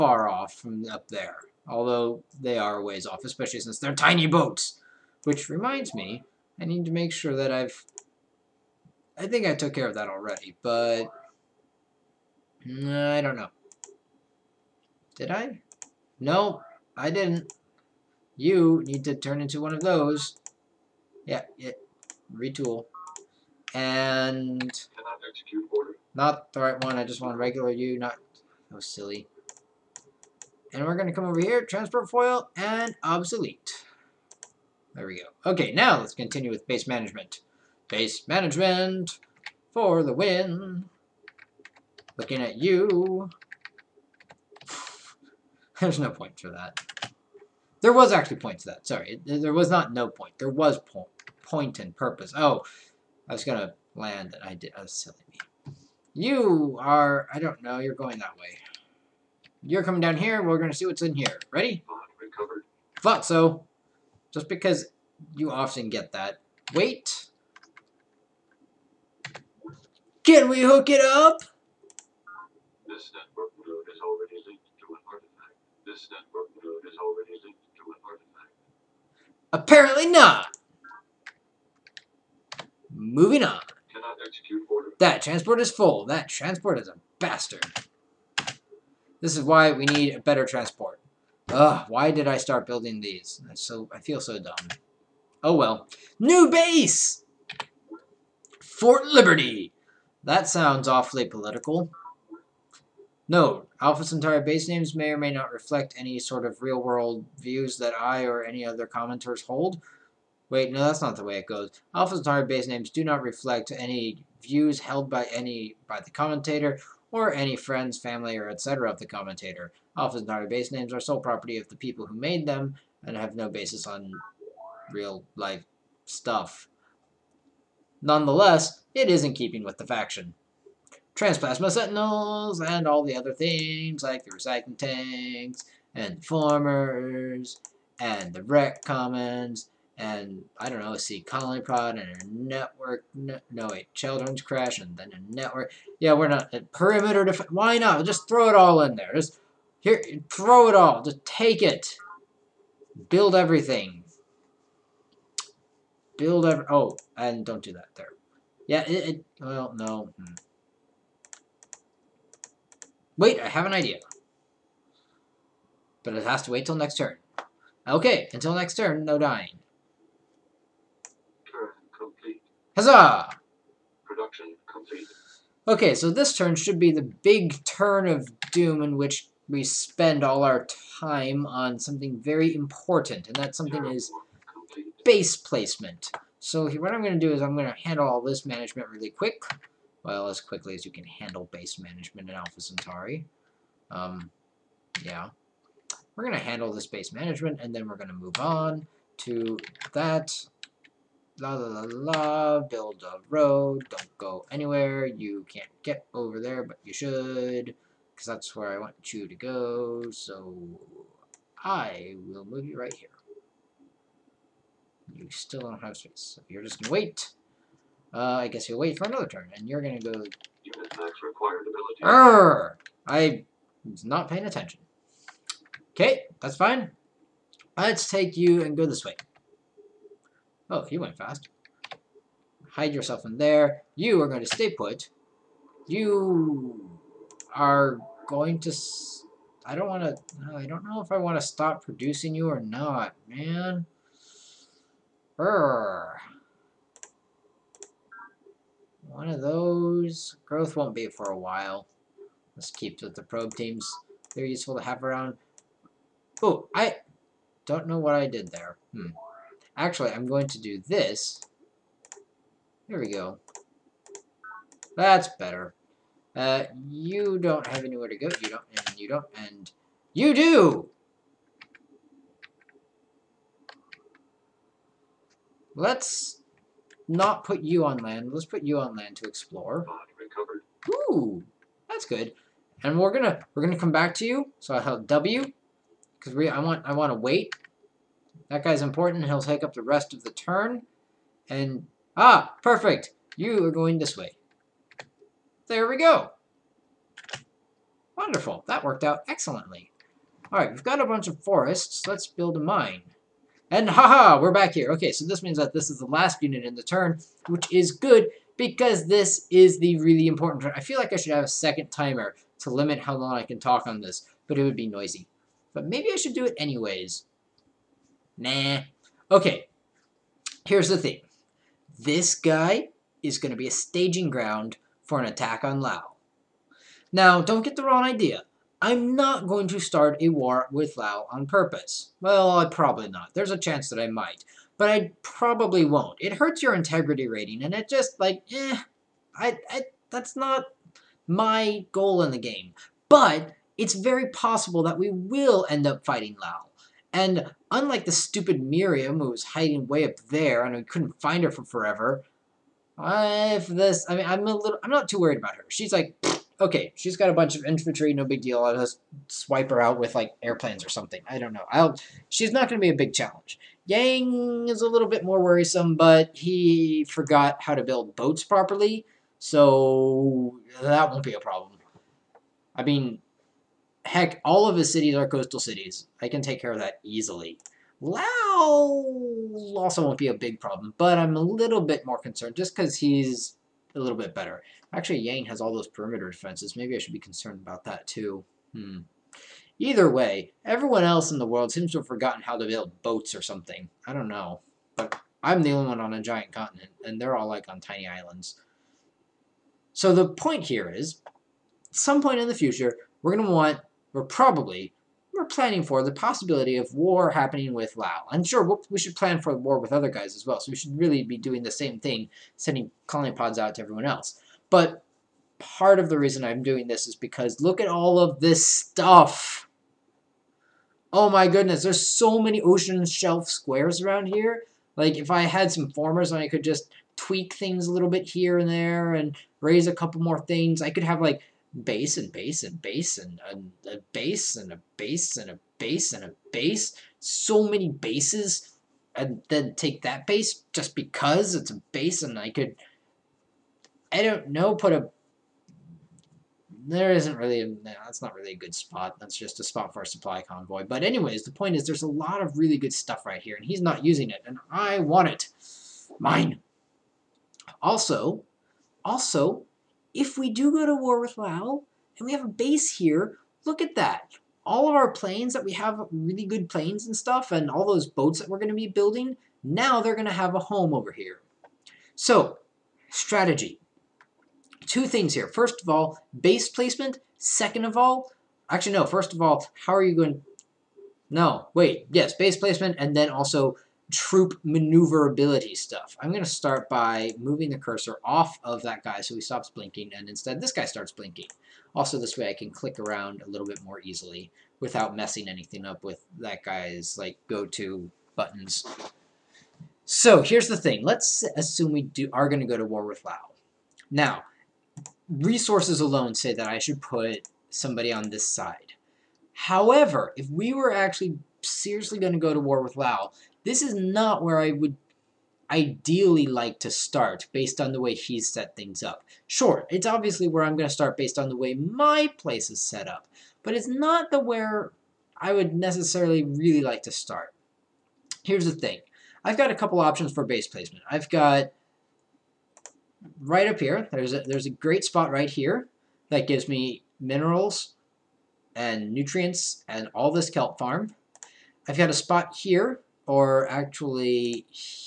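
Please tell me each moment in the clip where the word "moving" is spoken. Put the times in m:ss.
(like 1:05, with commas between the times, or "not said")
1:22, 8:07.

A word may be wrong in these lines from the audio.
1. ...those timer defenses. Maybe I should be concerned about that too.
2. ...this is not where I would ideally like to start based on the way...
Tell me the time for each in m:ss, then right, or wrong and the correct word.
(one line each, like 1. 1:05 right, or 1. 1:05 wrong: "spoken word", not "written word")
1. 6:25 wrong: "perimeter", not "timer"
2. 8:33 right.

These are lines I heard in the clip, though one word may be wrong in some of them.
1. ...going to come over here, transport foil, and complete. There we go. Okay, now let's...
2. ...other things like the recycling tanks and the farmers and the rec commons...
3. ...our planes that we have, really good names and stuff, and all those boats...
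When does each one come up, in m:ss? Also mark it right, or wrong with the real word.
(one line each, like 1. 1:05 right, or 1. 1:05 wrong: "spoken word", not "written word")
1. 0:30 wrong: "obsolete", not "complete"
2. 2:13 right
3. 7:44 wrong: "planes", not "names".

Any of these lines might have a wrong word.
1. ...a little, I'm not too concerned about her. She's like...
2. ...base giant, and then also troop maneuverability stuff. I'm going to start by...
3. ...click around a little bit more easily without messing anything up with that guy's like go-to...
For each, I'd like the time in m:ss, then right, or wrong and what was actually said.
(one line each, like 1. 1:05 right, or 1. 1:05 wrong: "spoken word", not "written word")
1. 5:54 wrong: "worried", not "concerned"
2. 8:02 wrong: "placement", not "giant"
3. 8:12 right.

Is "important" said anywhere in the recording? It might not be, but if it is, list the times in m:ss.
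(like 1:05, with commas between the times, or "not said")
3:02, 4:48, 5:10.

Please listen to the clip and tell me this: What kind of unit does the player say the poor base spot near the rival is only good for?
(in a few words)
Supply convoy.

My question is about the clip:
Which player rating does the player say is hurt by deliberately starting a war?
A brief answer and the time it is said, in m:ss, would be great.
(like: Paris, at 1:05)
Integrity rating, at 5:36.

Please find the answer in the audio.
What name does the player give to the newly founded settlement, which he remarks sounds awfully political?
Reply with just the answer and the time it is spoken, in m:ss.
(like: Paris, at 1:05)
Fort Liberty, at 1:38.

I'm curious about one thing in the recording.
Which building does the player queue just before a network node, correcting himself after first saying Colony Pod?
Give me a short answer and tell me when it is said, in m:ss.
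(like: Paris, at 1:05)
Children's Creche, at 2:23.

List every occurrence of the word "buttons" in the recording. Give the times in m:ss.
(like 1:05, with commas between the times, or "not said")
8:18.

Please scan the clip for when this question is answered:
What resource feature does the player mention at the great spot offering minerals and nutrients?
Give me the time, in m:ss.
9:00.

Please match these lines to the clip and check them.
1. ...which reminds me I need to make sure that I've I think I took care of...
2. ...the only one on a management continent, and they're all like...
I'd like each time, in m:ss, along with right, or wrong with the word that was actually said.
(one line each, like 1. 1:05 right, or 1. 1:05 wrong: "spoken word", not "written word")
1. 0:05 right
2. 6:35 wrong: "giant", not "management".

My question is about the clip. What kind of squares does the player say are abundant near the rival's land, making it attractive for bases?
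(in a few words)
Ocean shelf squares.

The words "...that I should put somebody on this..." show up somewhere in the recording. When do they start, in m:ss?
8:26.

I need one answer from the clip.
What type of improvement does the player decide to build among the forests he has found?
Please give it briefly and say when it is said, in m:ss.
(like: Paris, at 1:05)
A mine, at 5:02.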